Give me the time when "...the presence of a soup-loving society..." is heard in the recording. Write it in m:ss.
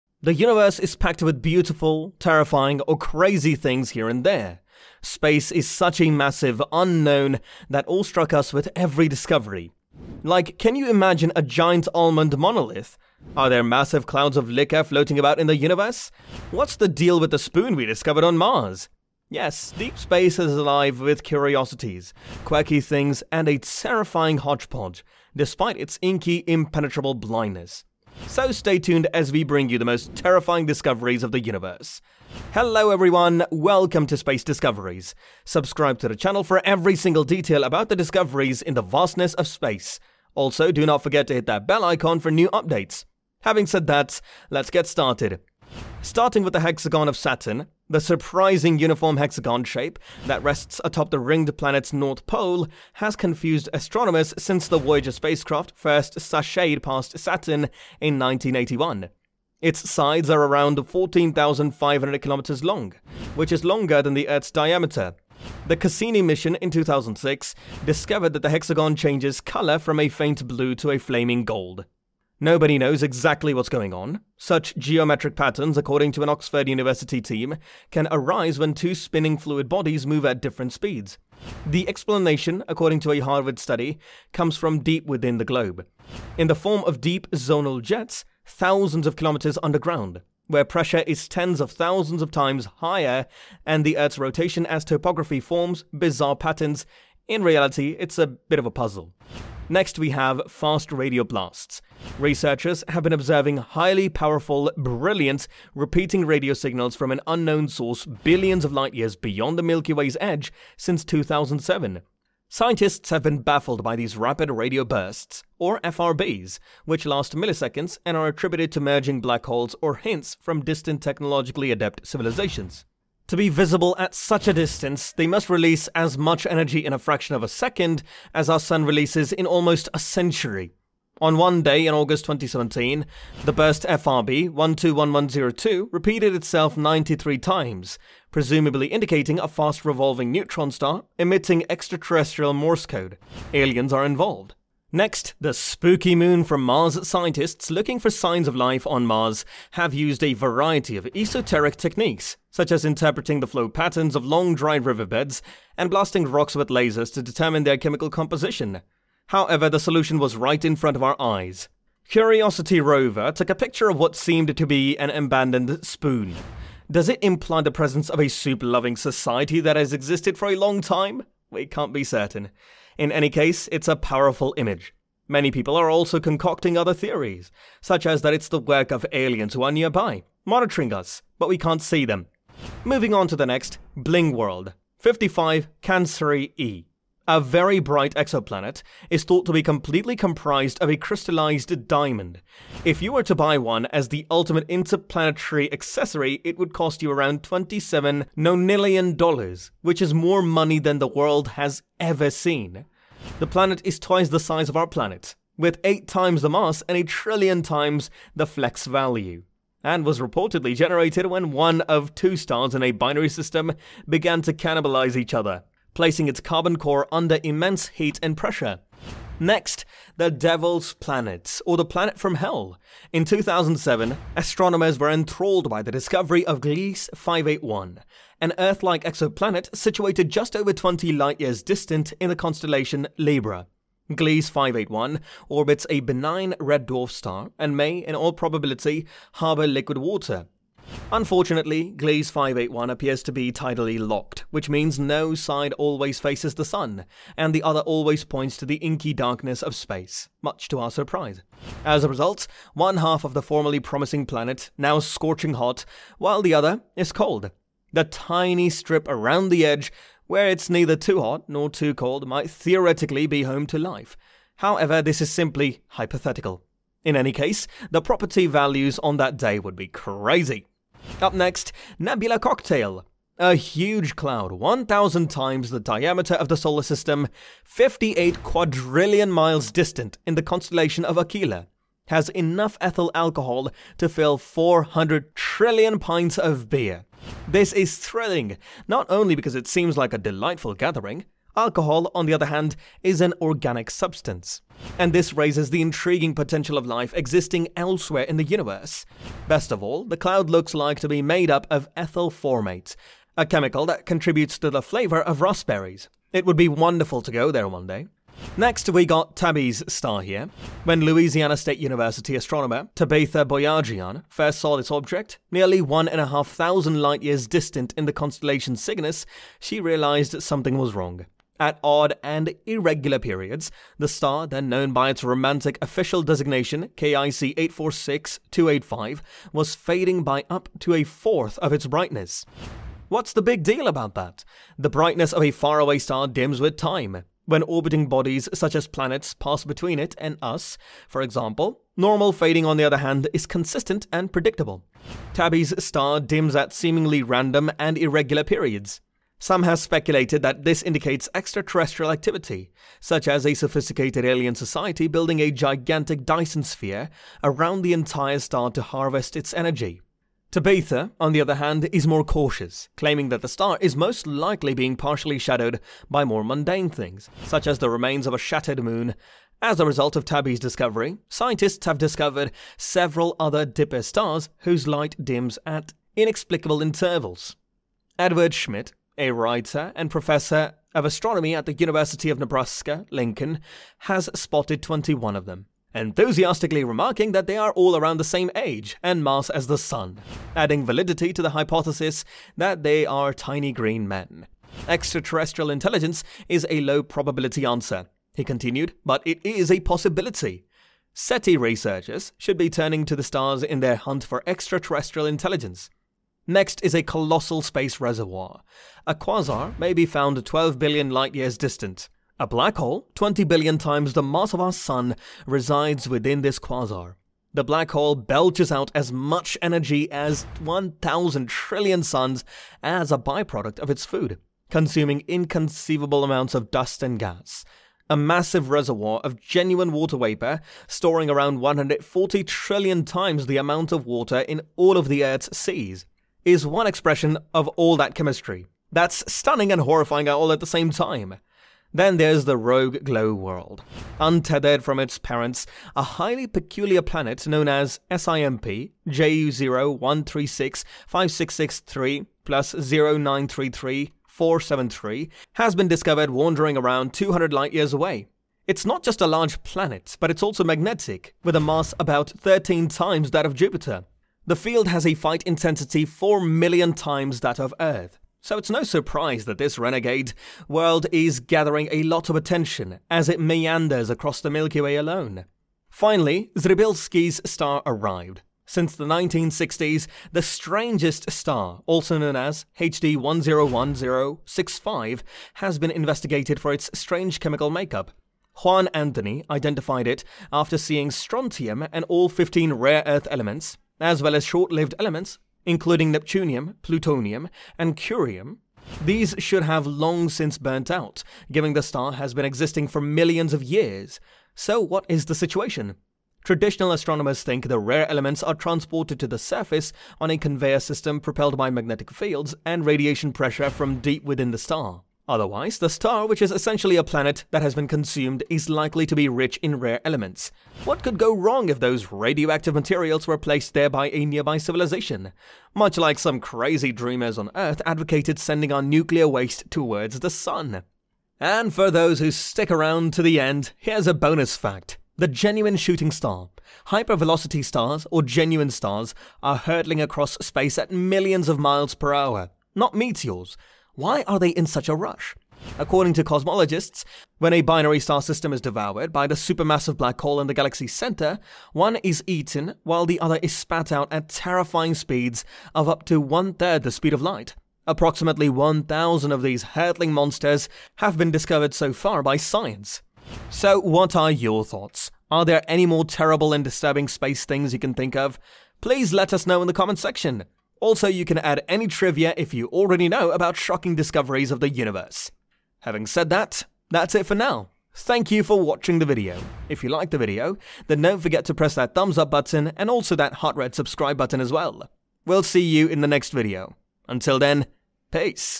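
2:47.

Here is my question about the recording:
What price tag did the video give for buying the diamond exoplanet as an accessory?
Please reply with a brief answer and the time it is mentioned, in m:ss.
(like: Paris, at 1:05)
27 nonillion dollars, at 3:17.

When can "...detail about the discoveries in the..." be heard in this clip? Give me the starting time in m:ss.
0:37.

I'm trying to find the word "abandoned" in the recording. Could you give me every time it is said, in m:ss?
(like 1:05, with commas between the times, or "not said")
2:45.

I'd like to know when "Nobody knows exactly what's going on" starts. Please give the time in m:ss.
1:12.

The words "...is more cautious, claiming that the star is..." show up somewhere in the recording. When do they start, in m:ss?
6:01.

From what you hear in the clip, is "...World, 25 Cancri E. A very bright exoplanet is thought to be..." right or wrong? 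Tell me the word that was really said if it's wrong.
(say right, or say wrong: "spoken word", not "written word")
wrong: "55", not "25".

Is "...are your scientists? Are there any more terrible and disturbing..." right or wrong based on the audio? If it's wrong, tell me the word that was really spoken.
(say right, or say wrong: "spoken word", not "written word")
wrong: "thoughts", not "scientists".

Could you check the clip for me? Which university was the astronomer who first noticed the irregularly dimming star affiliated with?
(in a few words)
Louisiana State University.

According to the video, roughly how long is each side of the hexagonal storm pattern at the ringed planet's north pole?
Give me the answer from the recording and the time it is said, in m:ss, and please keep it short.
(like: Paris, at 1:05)
14,500 kilometers, at 1:00.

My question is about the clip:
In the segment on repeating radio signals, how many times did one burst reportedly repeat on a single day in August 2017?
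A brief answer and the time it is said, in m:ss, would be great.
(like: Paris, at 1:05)
93, at 2:16.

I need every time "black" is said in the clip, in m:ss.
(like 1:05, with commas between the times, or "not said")
1:59, 6:52, 6:57, 9:09.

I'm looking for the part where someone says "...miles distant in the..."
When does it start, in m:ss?
4:39.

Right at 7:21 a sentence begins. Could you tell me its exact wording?
Then there's the Rogue Glow world.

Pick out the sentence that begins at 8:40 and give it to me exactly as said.
What could go wrong if those radioactive materials were placed there by a nearby civilization?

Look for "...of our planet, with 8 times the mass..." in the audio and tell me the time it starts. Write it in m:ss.
3:24.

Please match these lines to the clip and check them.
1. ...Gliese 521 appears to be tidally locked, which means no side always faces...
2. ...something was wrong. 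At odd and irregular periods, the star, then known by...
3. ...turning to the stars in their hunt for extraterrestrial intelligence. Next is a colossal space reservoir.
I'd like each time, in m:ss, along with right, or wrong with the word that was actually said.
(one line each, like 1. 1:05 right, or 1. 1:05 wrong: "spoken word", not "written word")
1. 4:01 wrong: "581", not "521"
2. 5:20 right
3. 6:42 right.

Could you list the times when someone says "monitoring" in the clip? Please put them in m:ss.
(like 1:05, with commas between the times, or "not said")
3:00.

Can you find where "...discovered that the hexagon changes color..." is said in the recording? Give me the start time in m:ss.
1:07.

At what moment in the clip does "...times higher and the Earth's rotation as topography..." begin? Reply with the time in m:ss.
1:32.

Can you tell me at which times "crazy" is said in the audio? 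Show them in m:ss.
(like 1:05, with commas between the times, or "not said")
0:02, 4:29, 8:46.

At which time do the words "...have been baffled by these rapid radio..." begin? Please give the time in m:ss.
1:53.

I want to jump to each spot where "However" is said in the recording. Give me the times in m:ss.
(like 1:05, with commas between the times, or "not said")
2:39, 4:24.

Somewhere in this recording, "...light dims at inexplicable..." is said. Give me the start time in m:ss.
6:14.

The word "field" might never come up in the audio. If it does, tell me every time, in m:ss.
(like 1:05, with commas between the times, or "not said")
7:44, 8:32.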